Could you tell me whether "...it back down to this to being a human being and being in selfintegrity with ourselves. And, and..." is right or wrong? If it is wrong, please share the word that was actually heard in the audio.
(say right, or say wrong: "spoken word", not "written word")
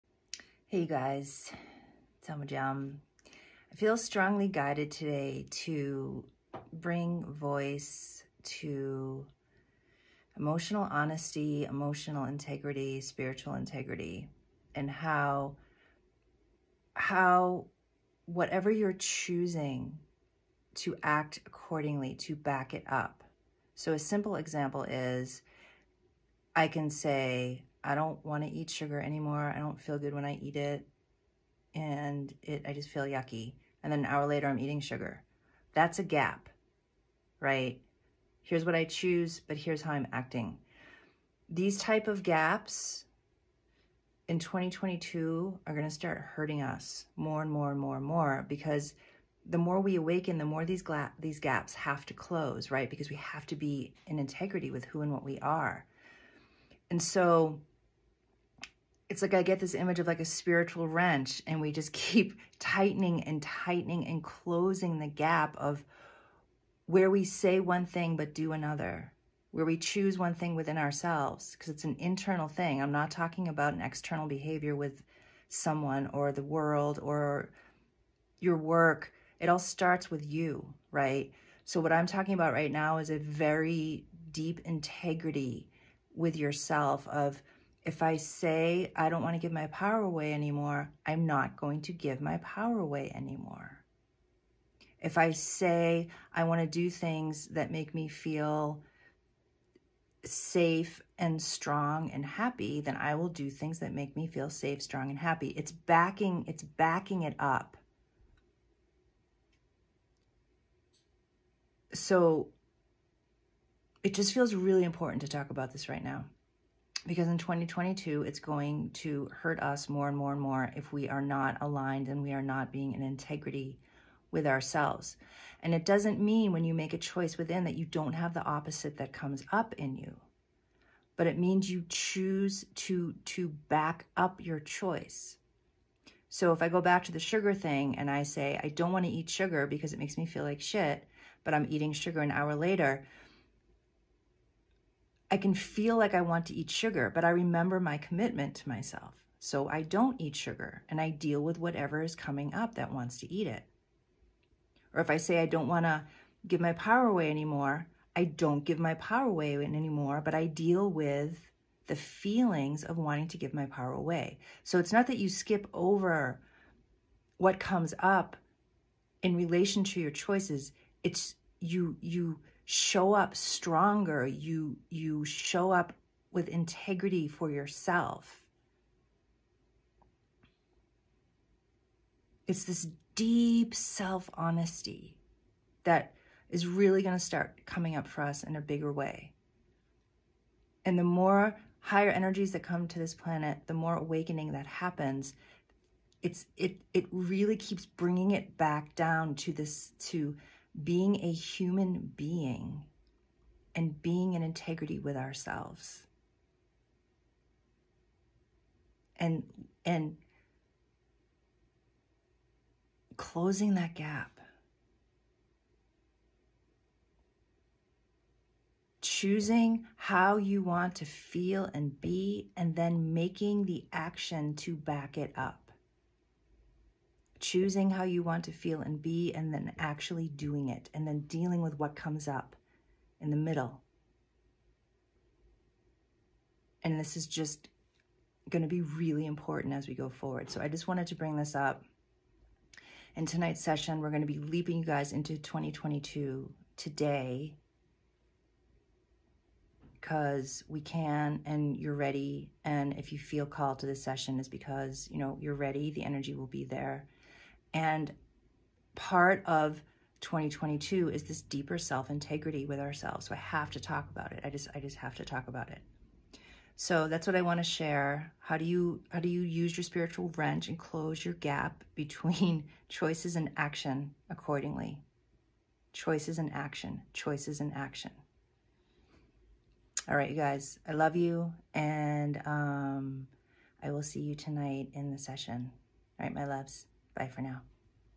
wrong: "integrity", not "selfintegrity".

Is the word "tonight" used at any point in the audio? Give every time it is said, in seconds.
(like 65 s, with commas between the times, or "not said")
243 s, 284 s.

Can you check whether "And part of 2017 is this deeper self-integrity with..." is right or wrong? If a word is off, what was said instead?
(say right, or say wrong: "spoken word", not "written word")
wrong: "2022", not "2017".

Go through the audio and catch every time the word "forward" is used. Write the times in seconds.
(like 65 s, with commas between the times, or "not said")
240 s.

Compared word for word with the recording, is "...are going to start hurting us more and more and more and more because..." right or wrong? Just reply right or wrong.
right.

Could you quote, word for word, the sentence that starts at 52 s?
Because we have to be in integrity with who and what we are.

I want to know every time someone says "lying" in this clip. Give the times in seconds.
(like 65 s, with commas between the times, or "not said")
not said.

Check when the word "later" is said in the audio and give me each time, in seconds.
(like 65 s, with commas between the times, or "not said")
34 s, 142 s.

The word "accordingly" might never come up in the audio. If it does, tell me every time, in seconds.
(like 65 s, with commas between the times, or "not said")
21 s, 274 s.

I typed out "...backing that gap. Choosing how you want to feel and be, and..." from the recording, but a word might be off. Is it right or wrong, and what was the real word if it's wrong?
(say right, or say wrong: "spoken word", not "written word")
wrong: "closing", not "backing".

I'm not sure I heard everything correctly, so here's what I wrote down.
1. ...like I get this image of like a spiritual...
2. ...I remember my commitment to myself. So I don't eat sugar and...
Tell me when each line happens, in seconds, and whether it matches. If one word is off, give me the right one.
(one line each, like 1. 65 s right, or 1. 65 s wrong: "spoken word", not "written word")
1. 59 s right
2. 147 s right.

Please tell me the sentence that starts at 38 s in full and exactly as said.
Here's what I choose, but here's how I'm acting.